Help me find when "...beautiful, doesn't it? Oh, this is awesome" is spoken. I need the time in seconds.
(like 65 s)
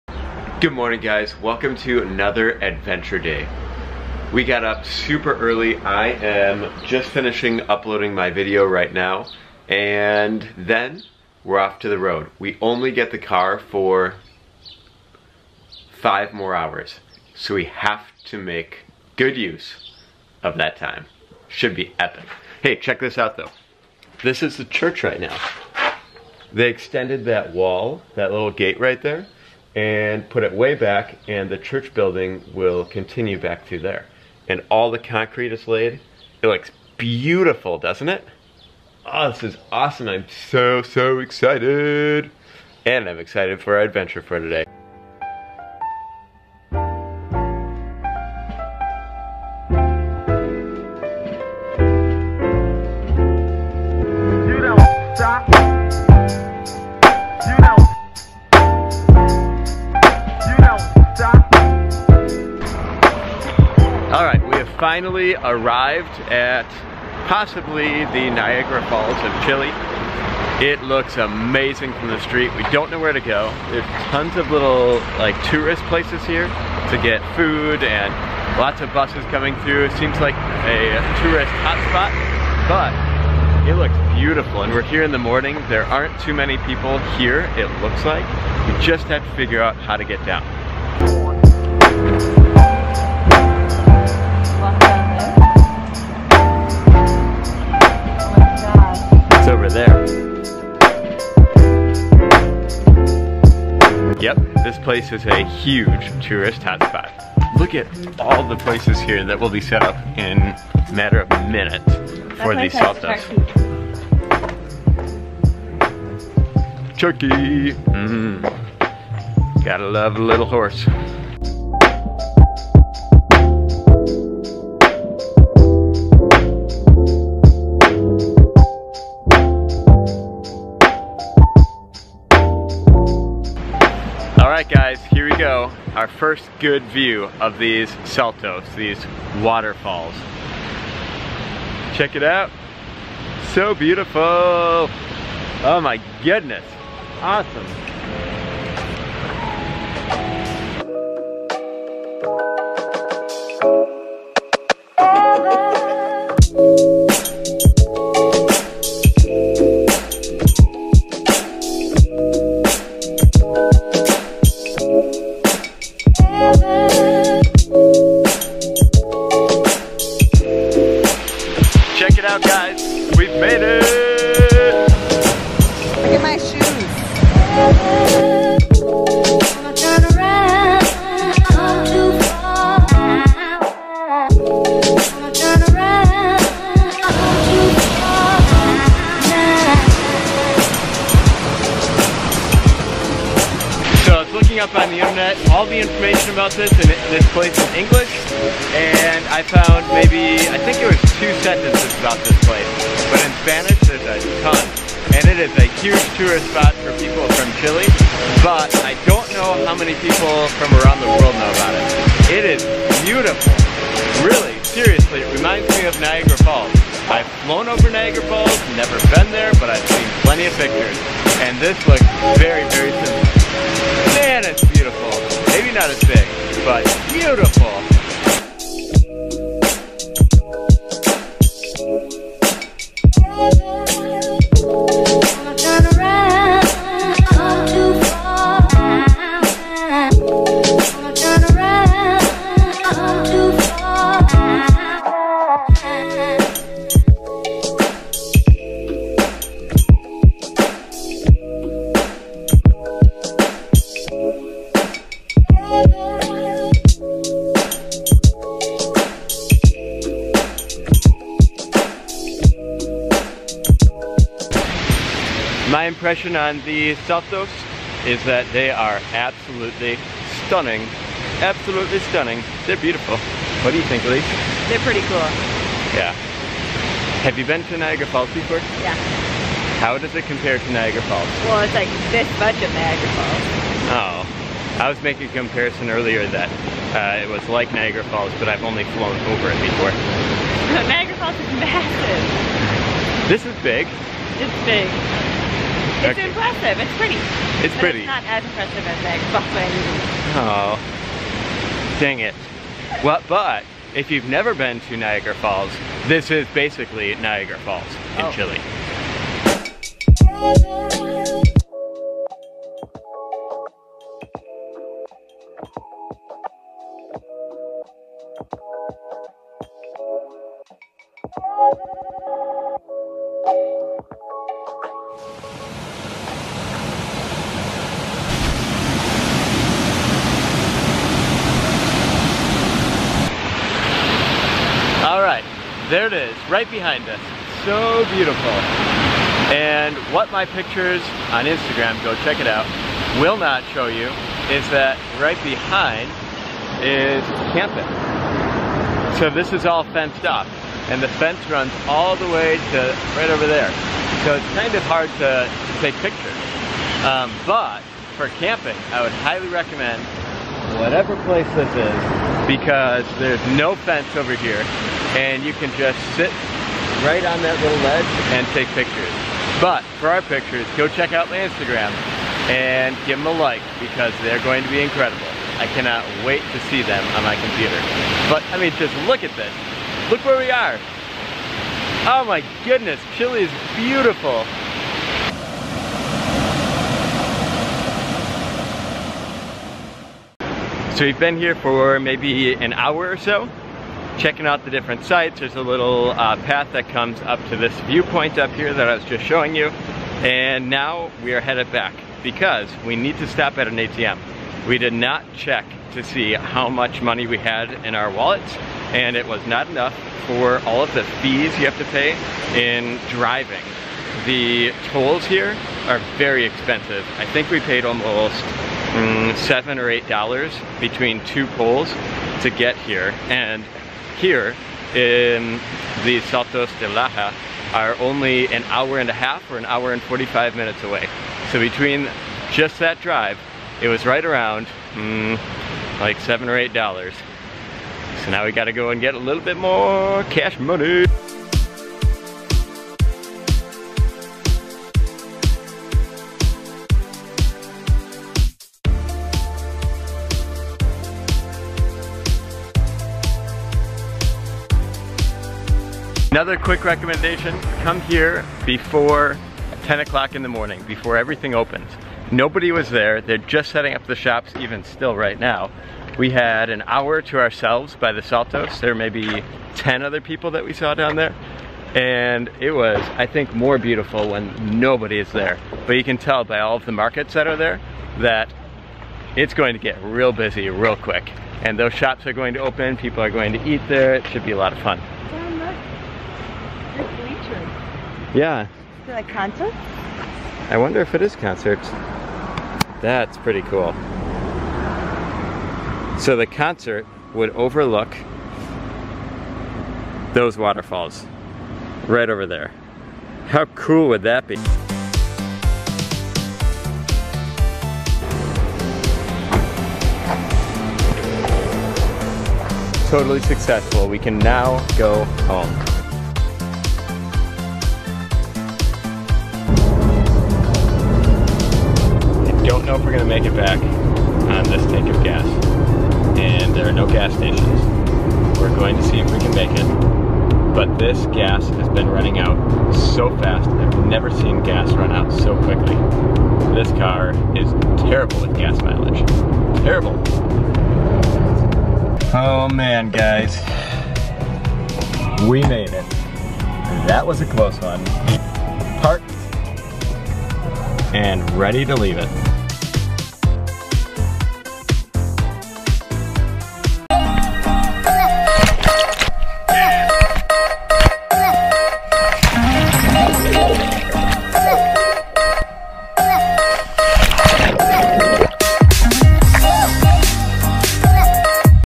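36 s.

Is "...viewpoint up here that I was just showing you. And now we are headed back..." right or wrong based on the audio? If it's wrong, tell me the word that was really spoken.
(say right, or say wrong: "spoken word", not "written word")
right.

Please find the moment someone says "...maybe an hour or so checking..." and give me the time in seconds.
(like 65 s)
391 s.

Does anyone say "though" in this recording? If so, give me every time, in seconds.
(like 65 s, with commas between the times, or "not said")
23 s.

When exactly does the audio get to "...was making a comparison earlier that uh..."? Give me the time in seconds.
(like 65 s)
284 s.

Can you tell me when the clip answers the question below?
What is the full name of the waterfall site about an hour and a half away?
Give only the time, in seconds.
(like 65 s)
426 s.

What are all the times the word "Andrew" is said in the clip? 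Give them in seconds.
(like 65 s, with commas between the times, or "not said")
not said.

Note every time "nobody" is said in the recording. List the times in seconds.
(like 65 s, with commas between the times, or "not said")
462 s, 474 s.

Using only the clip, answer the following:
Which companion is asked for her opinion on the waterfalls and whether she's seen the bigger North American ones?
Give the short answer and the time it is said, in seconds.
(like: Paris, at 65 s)
Elise, at 274 s.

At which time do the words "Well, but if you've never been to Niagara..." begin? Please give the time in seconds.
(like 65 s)
303 s.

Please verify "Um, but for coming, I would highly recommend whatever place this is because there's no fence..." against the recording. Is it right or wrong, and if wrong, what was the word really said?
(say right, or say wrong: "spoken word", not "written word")
wrong: "camping", not "coming".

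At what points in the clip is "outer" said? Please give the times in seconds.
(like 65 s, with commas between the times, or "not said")
not said.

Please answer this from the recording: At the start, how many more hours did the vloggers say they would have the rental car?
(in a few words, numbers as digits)
5.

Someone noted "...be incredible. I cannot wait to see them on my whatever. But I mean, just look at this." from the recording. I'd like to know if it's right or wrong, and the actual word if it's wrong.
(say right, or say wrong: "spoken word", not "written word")
wrong: "computer", not "whatever".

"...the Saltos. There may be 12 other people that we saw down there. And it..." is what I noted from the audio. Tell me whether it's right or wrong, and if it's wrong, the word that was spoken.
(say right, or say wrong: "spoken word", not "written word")
wrong: "10", not "12".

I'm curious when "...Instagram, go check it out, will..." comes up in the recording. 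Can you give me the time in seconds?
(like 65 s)
341 s.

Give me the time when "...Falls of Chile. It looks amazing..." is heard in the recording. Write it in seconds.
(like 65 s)
68 s.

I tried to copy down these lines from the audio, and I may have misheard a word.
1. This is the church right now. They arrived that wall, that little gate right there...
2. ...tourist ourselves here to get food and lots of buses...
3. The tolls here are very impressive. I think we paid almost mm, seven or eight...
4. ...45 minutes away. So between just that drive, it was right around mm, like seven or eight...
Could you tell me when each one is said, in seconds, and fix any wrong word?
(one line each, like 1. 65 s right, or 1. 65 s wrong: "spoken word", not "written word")
1. 24 s wrong: "extended", not "arrived"
2. 75 s wrong: "places", not "ourselves"
3. 414 s wrong: "expensive", not "impressive"
4. 430 s right.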